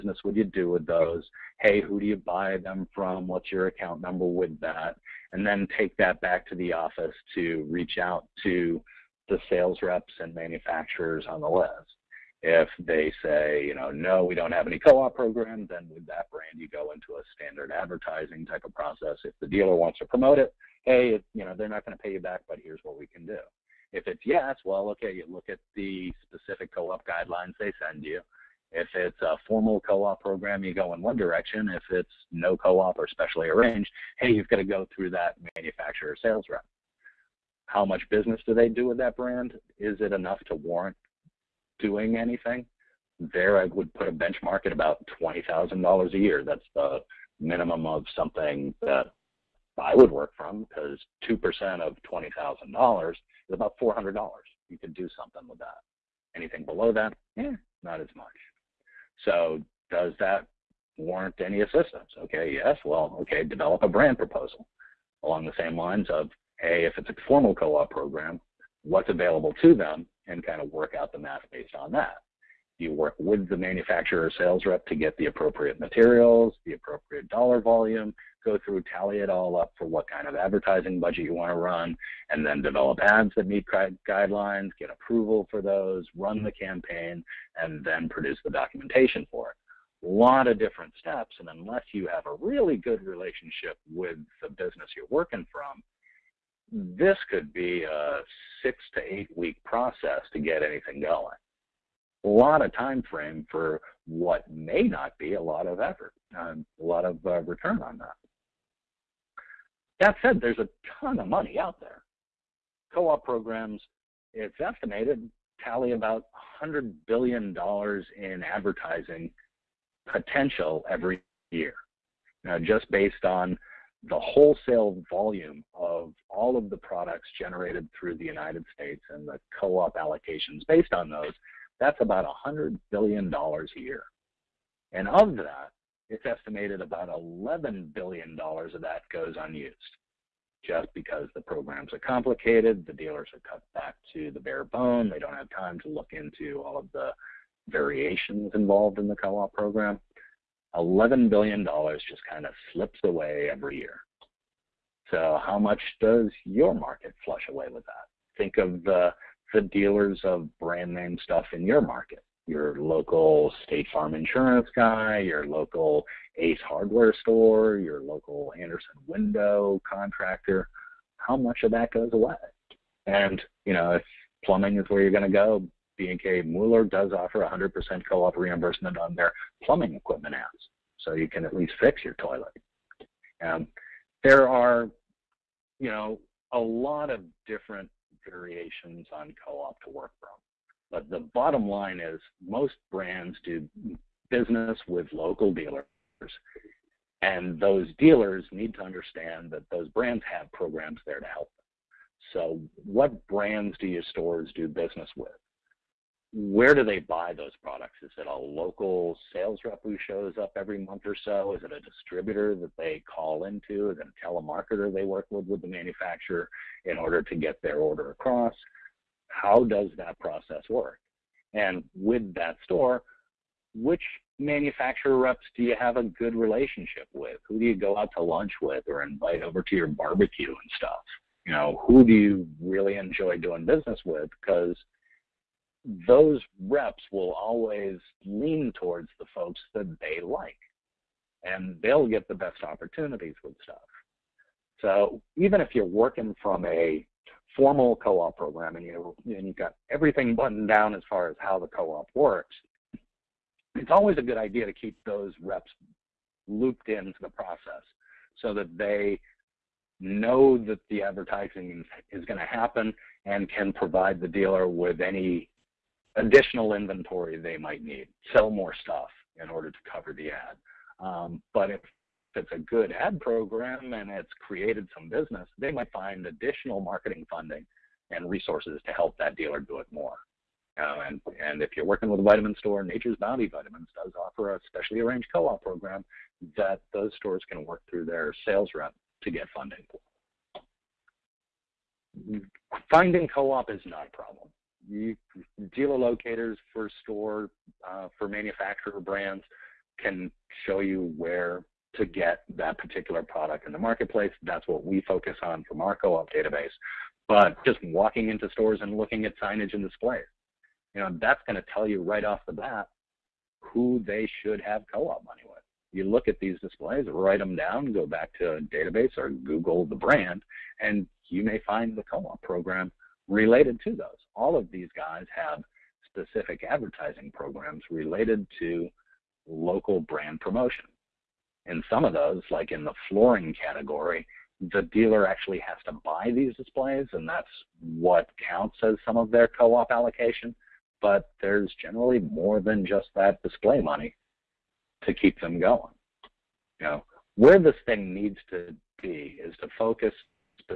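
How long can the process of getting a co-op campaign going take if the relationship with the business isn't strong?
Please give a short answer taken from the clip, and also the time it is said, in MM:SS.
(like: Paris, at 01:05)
6 to 8 weeks, at 01:38.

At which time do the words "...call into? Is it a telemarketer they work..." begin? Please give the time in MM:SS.
03:33.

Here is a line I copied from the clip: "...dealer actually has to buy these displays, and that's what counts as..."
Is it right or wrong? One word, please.
right.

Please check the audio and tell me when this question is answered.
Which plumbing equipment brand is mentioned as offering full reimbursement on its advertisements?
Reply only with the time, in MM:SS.
02:55.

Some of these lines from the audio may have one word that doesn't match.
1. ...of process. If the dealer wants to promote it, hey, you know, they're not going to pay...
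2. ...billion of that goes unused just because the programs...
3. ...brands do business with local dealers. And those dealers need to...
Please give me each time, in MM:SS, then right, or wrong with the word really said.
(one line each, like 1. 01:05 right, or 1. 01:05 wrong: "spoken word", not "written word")
1. 00:18 right
2. 02:17 right
3. 03:12 right.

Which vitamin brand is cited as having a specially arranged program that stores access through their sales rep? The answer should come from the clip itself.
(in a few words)
Nature's Bounty.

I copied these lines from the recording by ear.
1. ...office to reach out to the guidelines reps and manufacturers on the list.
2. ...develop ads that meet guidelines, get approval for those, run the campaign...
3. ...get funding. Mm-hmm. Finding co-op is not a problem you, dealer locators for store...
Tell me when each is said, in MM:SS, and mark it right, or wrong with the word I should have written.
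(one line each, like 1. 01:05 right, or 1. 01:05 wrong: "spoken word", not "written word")
1. 00:06 wrong: "sales", not "guidelines"
2. 01:22 right
3. 04:49 right.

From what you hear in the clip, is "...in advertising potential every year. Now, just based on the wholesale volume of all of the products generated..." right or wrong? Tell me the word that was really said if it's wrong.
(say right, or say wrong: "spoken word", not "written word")
right.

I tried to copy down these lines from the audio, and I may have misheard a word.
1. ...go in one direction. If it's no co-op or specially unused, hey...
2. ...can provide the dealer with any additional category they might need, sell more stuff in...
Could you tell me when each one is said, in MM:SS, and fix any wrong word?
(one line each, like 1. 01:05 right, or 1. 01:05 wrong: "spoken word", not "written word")
1. 00:30 wrong: "arranged", not "unused"
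2. 04:23 wrong: "inventory", not "category".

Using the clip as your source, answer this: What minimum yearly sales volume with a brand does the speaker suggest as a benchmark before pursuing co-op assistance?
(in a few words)
$20,000.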